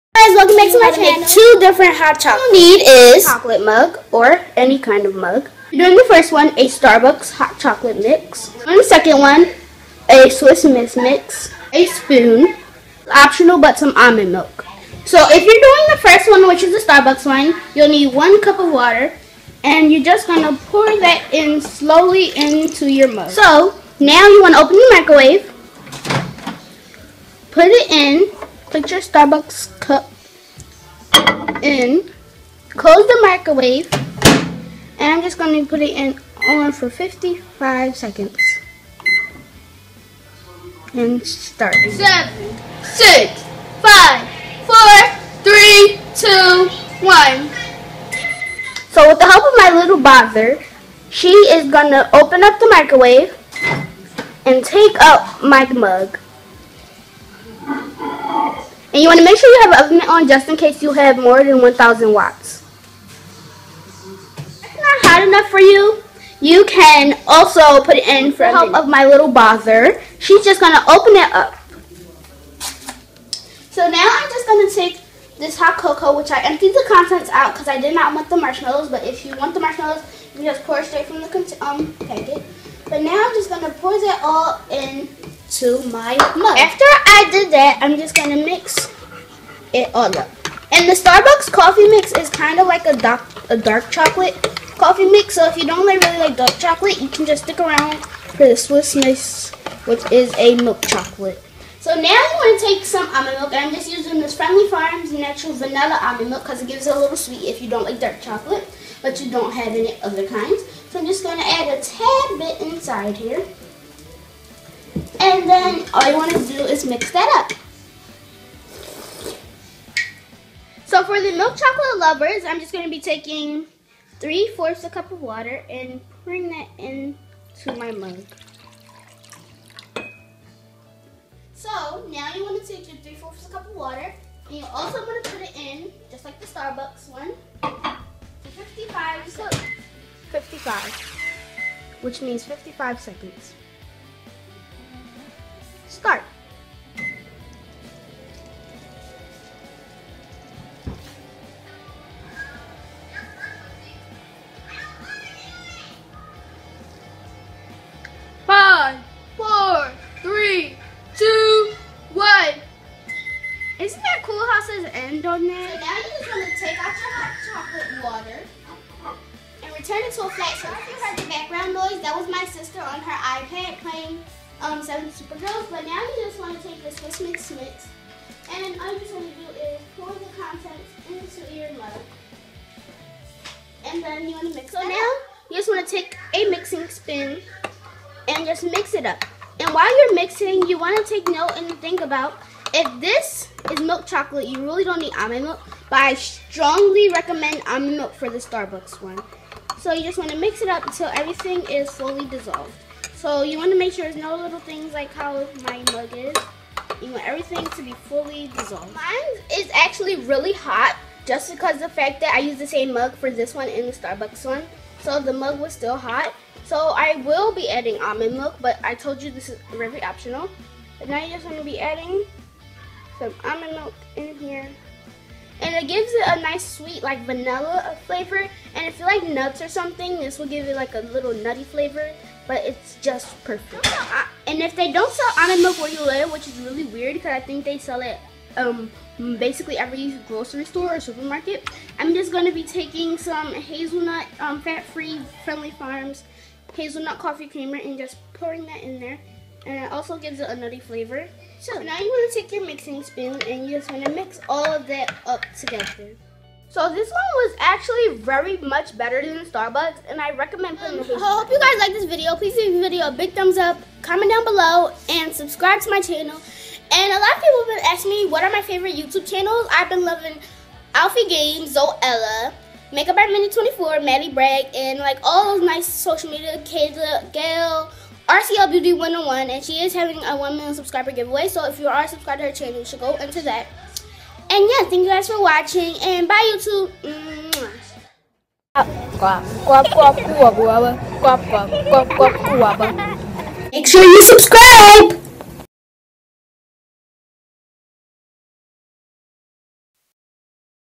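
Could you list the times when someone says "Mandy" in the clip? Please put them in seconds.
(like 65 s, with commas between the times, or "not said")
273 s.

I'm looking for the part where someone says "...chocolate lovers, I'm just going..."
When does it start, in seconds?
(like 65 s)
121 s.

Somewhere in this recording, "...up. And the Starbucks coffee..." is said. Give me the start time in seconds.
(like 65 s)
90 s.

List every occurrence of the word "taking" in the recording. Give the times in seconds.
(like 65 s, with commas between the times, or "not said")
122 s, 242 s.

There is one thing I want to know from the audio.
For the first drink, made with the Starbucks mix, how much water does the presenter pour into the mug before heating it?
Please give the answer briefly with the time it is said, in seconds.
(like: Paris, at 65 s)
1 cup, at 18 s.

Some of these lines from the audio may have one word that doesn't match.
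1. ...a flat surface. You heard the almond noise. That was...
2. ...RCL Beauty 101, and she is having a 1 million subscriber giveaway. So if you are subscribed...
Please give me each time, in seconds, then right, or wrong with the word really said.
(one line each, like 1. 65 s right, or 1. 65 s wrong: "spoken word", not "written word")
1. 170 s wrong: "background", not "almond"
2. 278 s right.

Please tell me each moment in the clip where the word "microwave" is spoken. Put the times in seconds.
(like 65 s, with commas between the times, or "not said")
24 s, 33 s, 52 s.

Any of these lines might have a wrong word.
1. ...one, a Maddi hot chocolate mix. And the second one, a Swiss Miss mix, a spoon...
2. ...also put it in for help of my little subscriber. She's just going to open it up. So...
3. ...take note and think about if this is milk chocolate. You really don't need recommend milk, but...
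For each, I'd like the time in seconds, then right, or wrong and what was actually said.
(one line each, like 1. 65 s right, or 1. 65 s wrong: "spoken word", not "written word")
1. 6 s wrong: "Starbucks", not "Maddi"
2. 67 s wrong: "bother", not "subscriber"
3. 191 s wrong: "almond", not "recommend".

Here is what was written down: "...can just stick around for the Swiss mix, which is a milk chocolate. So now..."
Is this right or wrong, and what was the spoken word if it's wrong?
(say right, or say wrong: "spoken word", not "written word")
right.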